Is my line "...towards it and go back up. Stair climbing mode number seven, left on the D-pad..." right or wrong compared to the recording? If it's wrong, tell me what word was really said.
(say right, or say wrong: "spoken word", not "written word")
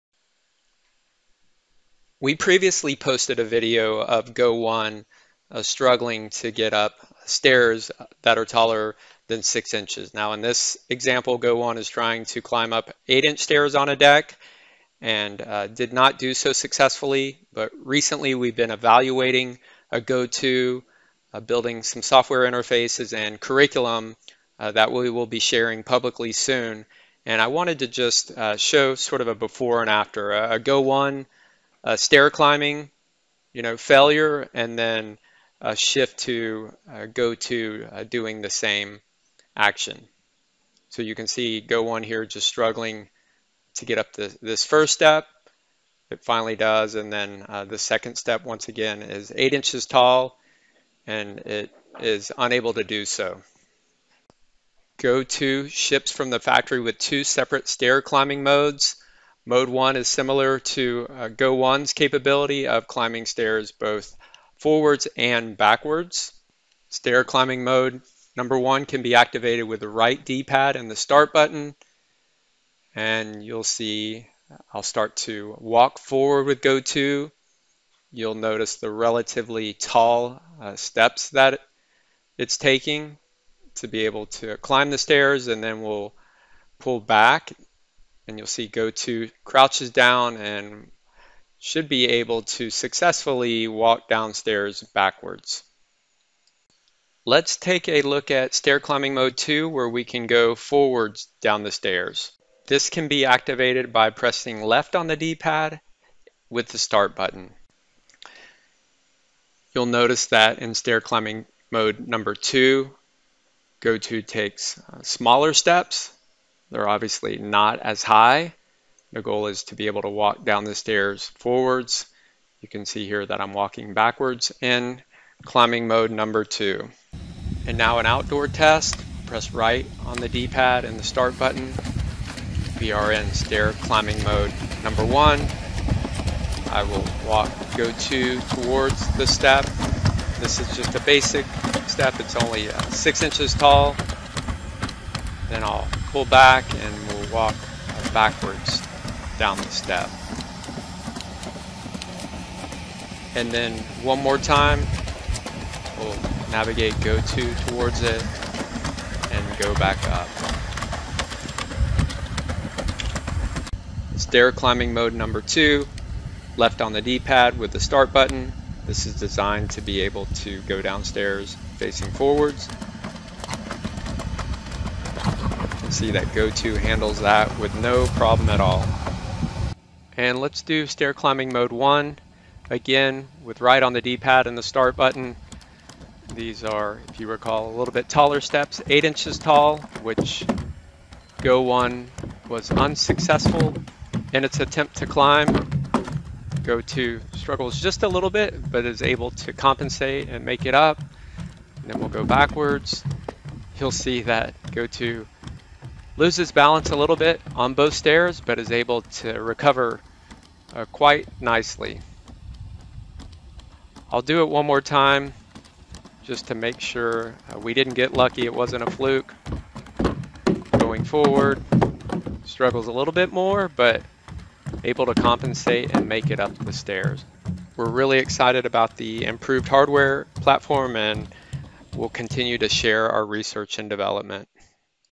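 wrong: "two", not "seven".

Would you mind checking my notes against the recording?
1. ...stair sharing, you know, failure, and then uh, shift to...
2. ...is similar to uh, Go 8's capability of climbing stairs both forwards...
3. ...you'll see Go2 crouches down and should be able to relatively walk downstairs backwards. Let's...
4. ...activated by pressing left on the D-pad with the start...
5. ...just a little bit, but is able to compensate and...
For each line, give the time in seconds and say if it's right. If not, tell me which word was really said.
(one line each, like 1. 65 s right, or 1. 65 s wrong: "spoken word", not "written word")
1. 31 s wrong: "climbing", not "sharing"
2. 59 s wrong: "1", not "8"
3. 88 s wrong: "successfully", not "relatively"
4. 103 s right
5. 197 s right.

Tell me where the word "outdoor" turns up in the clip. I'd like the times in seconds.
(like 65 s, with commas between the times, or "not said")
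128 s.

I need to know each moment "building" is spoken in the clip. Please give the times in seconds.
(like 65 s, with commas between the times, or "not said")
21 s.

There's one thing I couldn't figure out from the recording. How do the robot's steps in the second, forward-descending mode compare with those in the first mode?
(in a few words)
Smaller steps.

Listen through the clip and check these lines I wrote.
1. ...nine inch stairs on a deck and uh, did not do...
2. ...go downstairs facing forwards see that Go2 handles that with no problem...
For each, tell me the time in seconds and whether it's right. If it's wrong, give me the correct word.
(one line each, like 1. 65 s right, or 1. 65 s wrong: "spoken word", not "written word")
1. 13 s wrong: "eight", not "nine"
2. 170 s right.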